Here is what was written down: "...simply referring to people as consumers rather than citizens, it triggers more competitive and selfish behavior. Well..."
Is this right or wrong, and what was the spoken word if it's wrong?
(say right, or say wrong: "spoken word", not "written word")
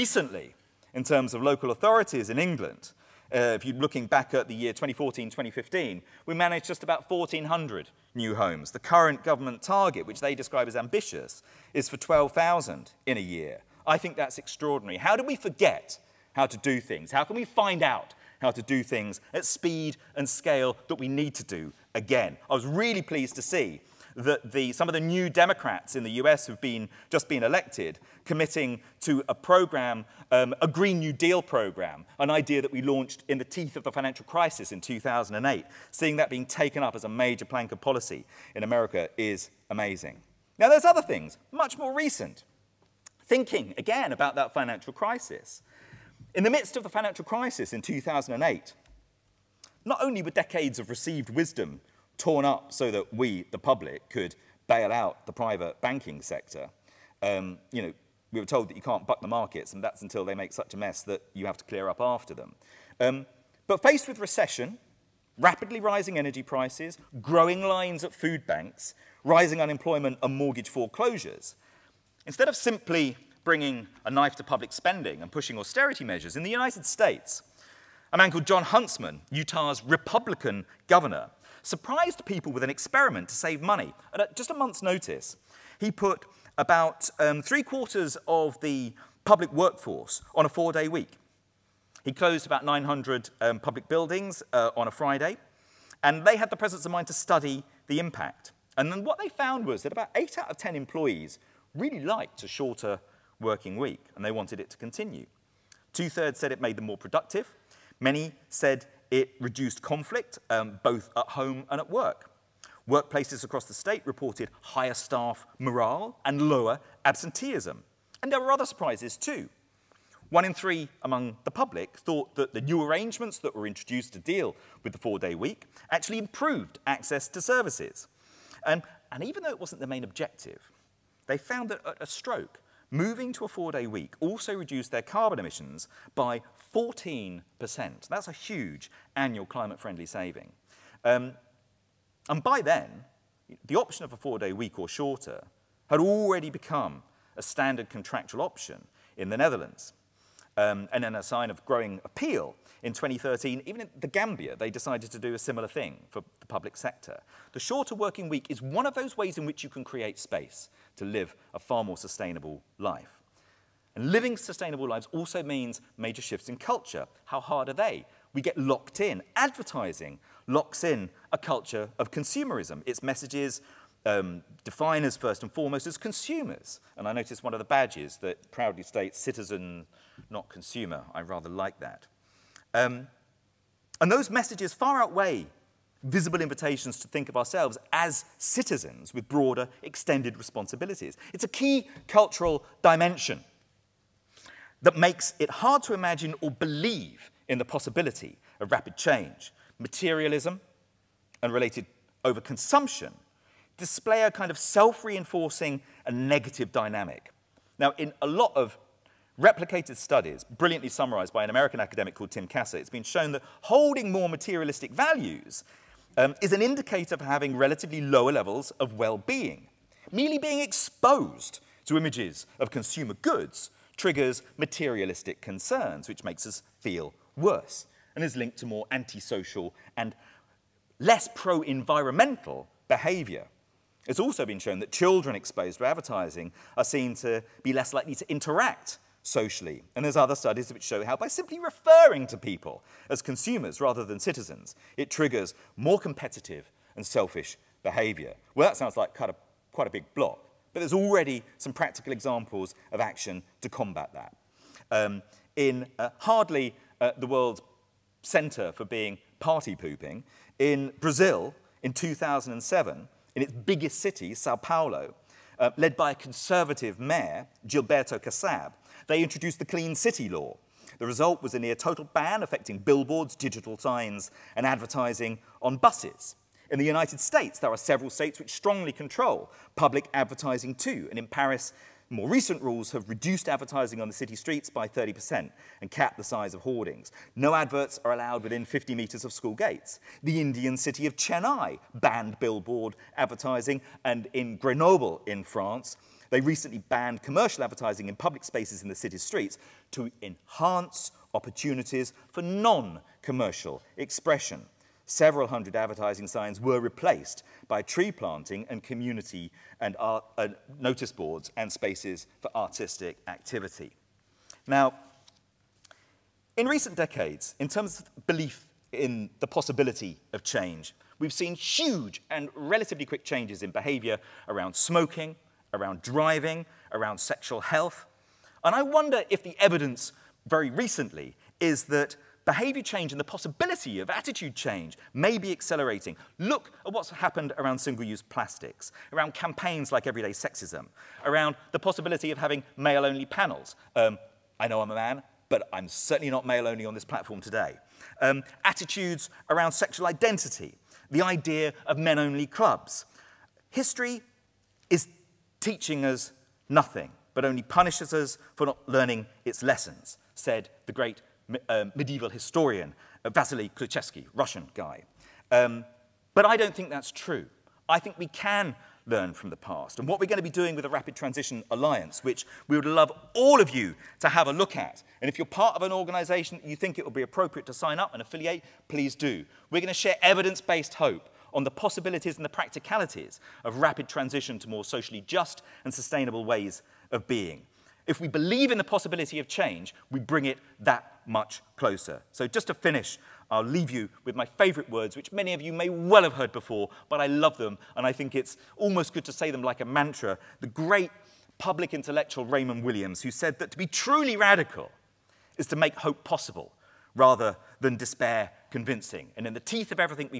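right.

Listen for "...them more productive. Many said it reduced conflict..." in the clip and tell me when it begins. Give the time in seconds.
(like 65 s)
106 s.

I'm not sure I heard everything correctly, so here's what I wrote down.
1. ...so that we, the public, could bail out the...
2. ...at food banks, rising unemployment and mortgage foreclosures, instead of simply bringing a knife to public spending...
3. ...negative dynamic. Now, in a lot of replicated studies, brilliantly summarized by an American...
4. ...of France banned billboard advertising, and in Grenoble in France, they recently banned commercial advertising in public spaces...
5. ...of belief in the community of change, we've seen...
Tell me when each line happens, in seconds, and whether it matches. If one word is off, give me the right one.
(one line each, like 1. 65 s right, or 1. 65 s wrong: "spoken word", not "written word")
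1. 52 s right
2. 68 s right
3. 206 s right
4. 291 s wrong: "Chennai", not "France"
5. 317 s wrong: "possibility", not "community".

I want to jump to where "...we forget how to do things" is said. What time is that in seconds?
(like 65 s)
15 s.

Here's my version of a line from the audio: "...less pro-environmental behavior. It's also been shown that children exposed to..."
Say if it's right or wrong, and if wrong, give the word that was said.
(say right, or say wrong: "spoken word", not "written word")
right.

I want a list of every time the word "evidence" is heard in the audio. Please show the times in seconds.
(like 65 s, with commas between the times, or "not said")
329 s, 380 s.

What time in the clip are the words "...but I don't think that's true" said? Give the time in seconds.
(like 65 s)
366 s.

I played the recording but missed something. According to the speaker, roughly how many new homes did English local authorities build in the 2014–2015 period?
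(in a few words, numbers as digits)
1,400.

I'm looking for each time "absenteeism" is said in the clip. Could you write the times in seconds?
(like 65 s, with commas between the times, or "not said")
117 s.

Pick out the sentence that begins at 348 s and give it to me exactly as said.
Um, attitudes around sexual identity, the idea of men only clubs.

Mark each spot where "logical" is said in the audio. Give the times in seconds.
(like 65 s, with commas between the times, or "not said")
not said.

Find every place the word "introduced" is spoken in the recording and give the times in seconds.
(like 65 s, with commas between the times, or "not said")
123 s, 269 s.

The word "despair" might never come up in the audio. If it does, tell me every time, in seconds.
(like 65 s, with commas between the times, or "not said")
407 s.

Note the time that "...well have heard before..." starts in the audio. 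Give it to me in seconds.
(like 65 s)
395 s.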